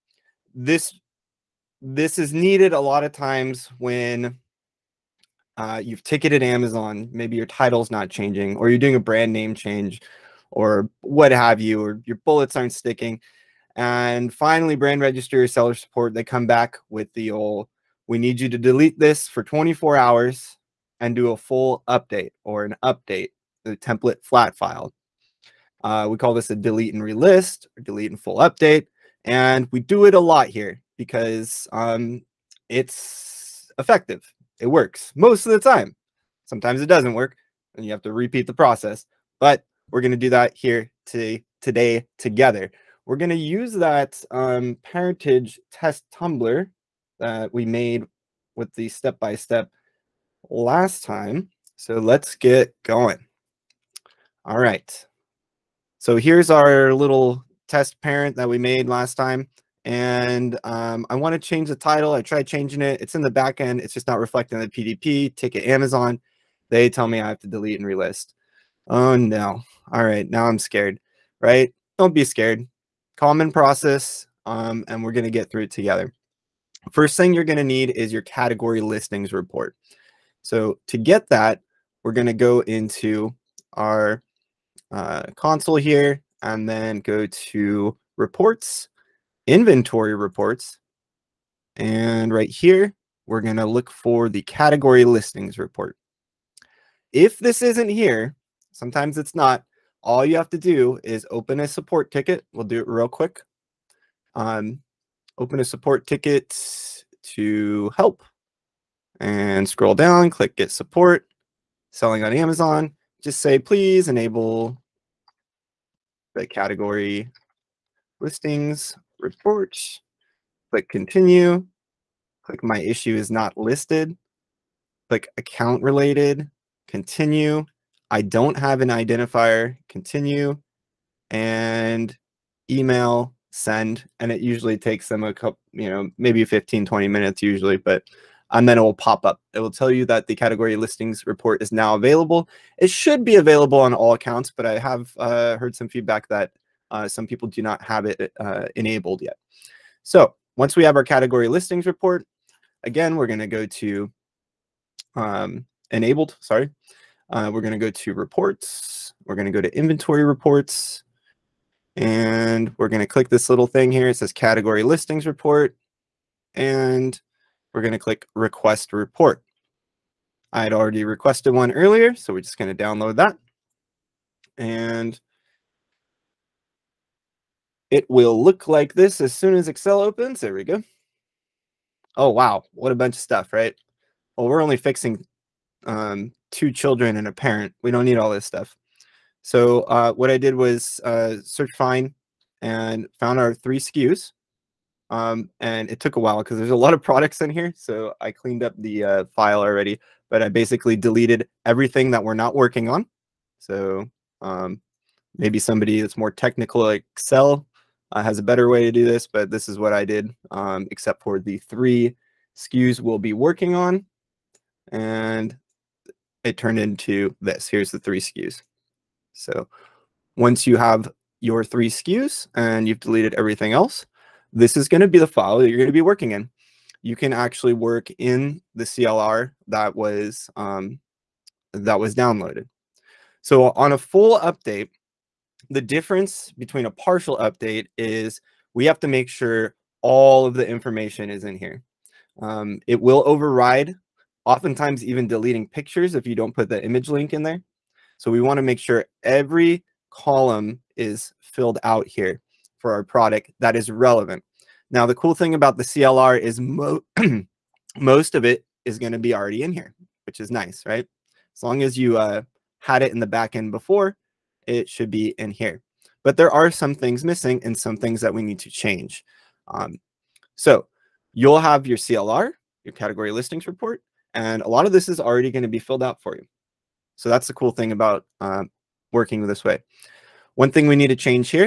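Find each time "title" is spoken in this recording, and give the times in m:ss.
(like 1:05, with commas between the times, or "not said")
0:07, 1:01.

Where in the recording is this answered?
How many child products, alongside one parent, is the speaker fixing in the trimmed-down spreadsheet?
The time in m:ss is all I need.
3:06.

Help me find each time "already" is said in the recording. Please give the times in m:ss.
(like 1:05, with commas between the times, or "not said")
2:50, 3:19, 4:19, 4:35.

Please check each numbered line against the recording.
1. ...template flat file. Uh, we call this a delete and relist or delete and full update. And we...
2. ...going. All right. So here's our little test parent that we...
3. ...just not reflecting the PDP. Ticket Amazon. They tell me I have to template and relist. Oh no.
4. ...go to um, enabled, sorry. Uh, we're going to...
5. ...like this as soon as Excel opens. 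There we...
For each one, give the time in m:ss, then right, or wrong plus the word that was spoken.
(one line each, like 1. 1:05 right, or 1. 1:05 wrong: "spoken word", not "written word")
1. 0:23 right
2. 0:52 right
3. 1:03 wrong: "delete", not "template"
4. 2:33 right
5. 2:58 right.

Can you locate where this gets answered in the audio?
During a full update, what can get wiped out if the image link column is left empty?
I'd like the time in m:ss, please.
4:05.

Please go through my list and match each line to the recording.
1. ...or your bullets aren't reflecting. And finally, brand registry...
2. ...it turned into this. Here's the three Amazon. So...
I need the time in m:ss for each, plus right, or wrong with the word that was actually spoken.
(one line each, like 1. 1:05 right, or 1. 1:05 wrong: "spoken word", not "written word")
1. 0:11 wrong: "sticking", not "reflecting"
2. 3:36 wrong: "SKUs", not "Amazon".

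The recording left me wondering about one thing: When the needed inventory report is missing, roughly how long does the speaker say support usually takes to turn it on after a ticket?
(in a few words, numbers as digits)
15, 20 minutes.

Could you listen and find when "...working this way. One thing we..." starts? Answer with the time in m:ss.
4:39.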